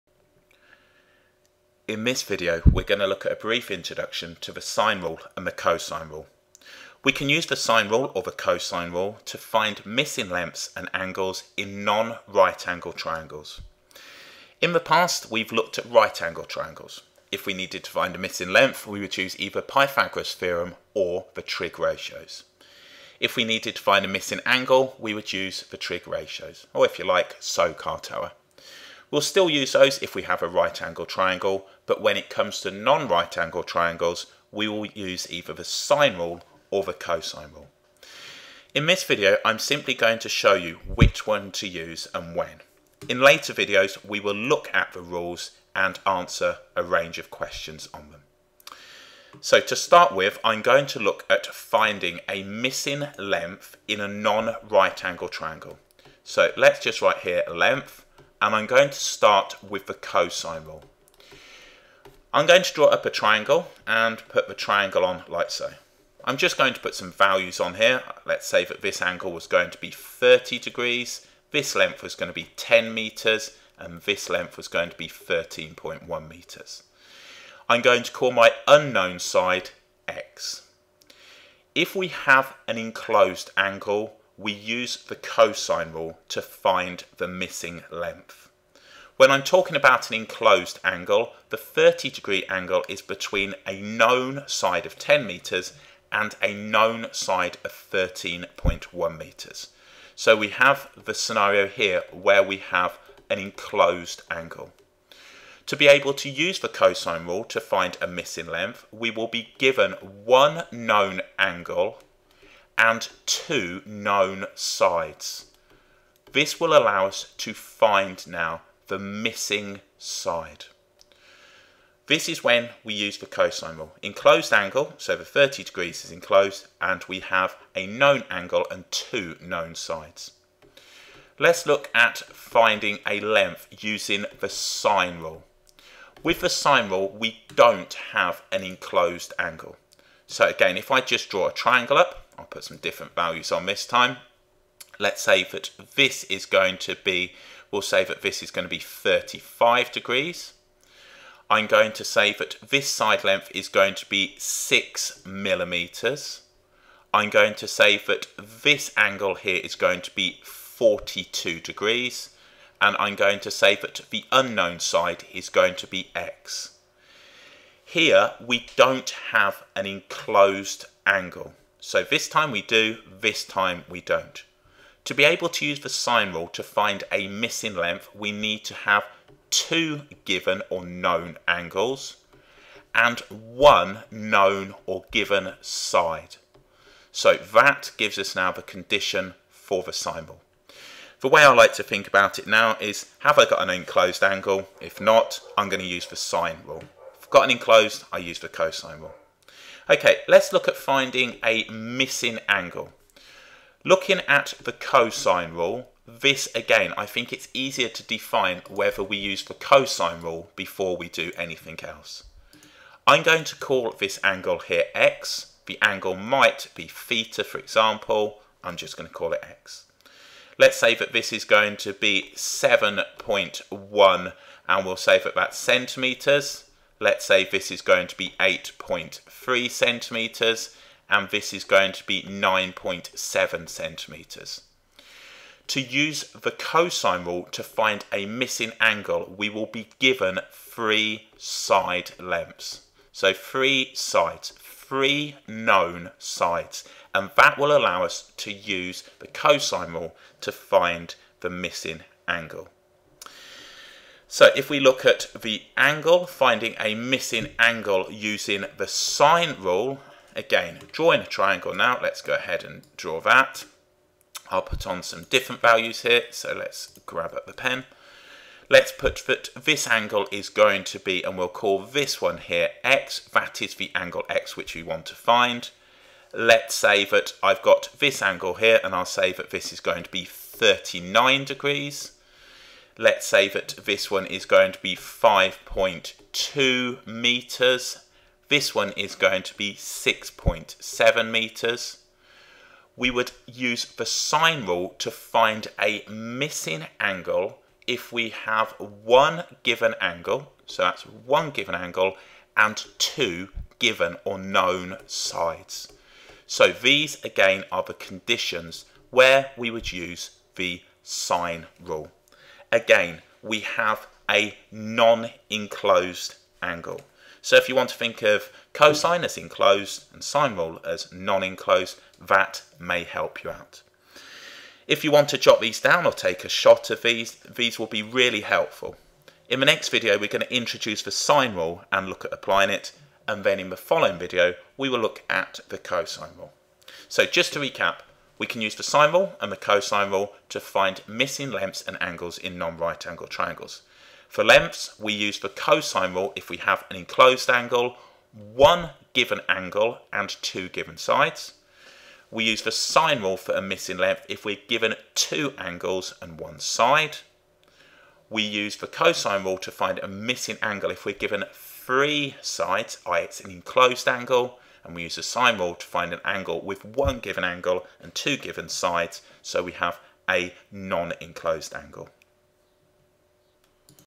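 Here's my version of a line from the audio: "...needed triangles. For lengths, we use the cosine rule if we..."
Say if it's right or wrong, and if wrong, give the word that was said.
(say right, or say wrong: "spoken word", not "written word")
wrong: "angled", not "needed".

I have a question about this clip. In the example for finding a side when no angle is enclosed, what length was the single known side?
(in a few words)
6 millimetres.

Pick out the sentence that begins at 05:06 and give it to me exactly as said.
So these again are the conditions where we would use the sine rule again, we have a non-enclosed angle.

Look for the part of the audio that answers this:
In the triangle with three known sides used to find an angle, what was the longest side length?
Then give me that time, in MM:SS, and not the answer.
03:52.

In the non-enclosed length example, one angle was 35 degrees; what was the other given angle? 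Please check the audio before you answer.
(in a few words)
42 degrees.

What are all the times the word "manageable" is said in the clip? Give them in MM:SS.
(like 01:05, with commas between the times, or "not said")
not said.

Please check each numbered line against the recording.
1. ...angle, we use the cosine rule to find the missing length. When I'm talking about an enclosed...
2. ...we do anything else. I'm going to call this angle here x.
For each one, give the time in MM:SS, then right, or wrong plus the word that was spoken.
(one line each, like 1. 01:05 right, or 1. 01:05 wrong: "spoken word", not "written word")
1. 01:23 right
2. 03:30 right.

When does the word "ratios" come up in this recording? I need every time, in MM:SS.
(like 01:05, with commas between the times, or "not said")
00:21, 00:26.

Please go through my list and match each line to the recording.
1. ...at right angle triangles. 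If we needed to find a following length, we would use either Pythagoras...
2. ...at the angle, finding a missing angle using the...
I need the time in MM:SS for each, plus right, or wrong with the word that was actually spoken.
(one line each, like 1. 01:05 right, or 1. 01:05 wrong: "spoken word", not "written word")
1. 00:15 wrong: "missing", not "following"
2. 04:15 right.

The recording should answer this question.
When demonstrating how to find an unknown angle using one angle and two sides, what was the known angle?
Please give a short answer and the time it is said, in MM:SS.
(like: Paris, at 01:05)
39 degrees, at 04:40.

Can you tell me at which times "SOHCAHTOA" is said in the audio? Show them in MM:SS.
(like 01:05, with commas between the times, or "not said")
00:27.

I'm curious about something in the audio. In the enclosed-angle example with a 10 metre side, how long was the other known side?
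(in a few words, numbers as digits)
13.1 metres.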